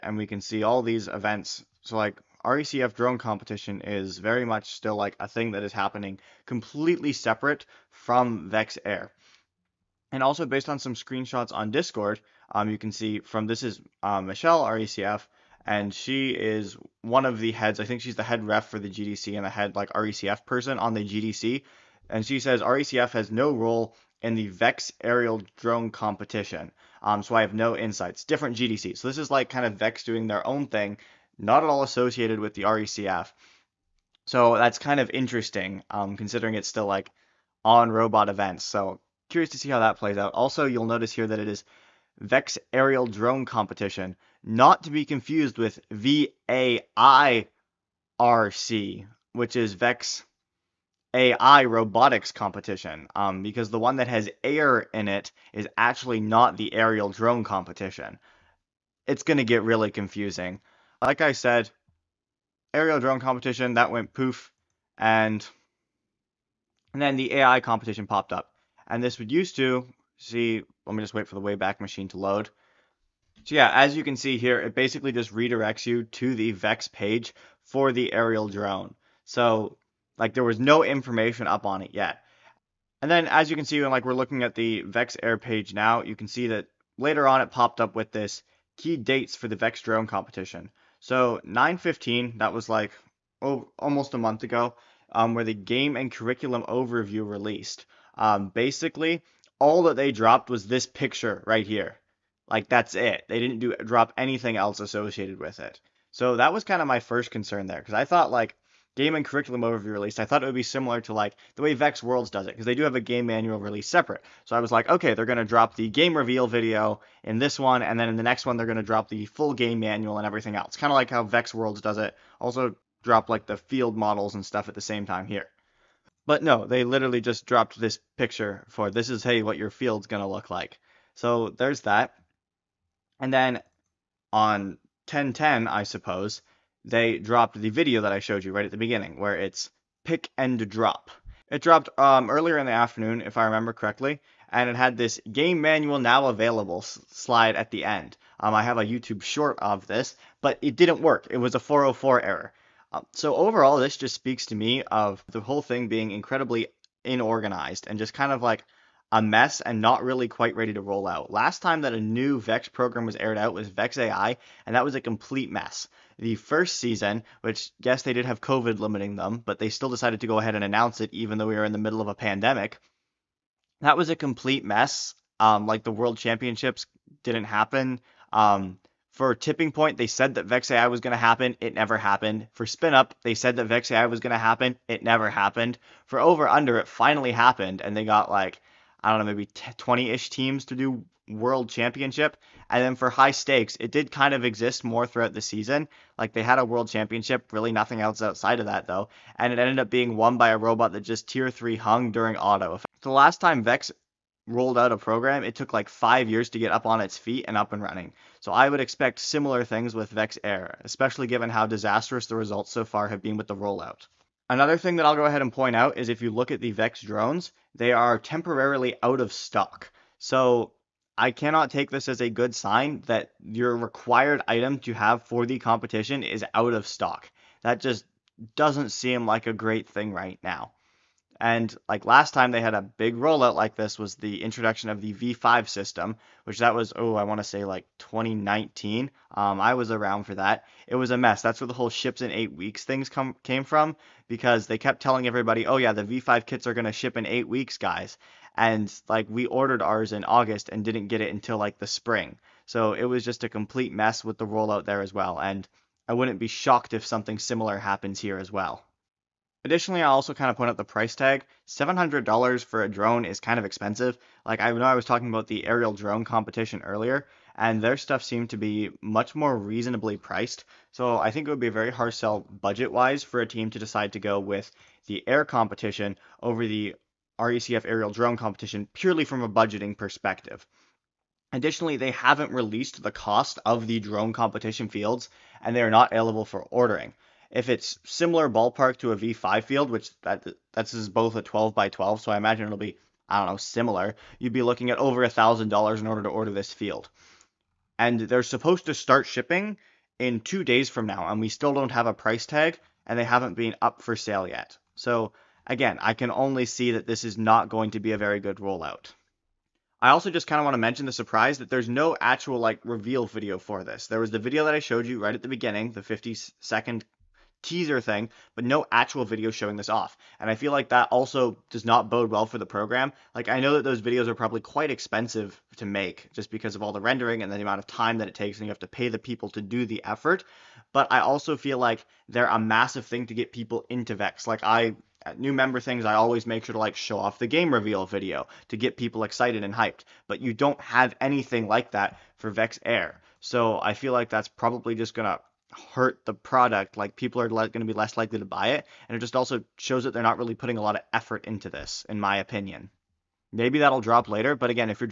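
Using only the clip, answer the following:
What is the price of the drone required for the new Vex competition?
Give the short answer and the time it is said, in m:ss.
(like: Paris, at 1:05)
$700, at 4:21.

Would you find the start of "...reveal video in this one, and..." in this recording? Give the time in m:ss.
1:56.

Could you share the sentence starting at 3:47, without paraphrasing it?
That just doesn't seem like a great thing right now.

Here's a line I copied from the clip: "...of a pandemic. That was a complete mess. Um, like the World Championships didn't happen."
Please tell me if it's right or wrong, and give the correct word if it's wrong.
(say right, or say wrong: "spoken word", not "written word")
right.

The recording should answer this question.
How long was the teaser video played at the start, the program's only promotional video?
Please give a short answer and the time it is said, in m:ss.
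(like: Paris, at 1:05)
50 seconds, at 5:16.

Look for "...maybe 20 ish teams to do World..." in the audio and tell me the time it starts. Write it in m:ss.
3:09.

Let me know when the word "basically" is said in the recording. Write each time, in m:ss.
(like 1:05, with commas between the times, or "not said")
1:14, 1:38.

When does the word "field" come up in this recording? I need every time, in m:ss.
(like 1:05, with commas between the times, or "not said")
2:03, 2:09, 4:44, 4:49, 4:56.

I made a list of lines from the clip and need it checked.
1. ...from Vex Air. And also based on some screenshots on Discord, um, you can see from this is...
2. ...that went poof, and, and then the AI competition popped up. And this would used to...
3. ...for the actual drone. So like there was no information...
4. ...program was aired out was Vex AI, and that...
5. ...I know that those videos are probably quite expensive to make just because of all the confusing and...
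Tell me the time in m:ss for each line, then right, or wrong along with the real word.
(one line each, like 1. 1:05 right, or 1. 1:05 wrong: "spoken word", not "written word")
1. 0:07 right
2. 1:03 right
3. 1:17 wrong: "aerial", not "actual"
4. 2:42 right
5. 5:23 wrong: "rendering", not "confusing".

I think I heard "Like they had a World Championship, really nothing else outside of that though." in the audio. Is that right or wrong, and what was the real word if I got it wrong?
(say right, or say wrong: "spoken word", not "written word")
right.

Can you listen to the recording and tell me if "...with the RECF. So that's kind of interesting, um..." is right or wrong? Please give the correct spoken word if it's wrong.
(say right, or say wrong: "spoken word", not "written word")
right.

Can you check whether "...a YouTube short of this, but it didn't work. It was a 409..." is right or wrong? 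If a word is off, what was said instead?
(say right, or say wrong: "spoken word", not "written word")
wrong: "404", not "409".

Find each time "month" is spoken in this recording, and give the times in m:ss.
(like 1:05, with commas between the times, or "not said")
1:34.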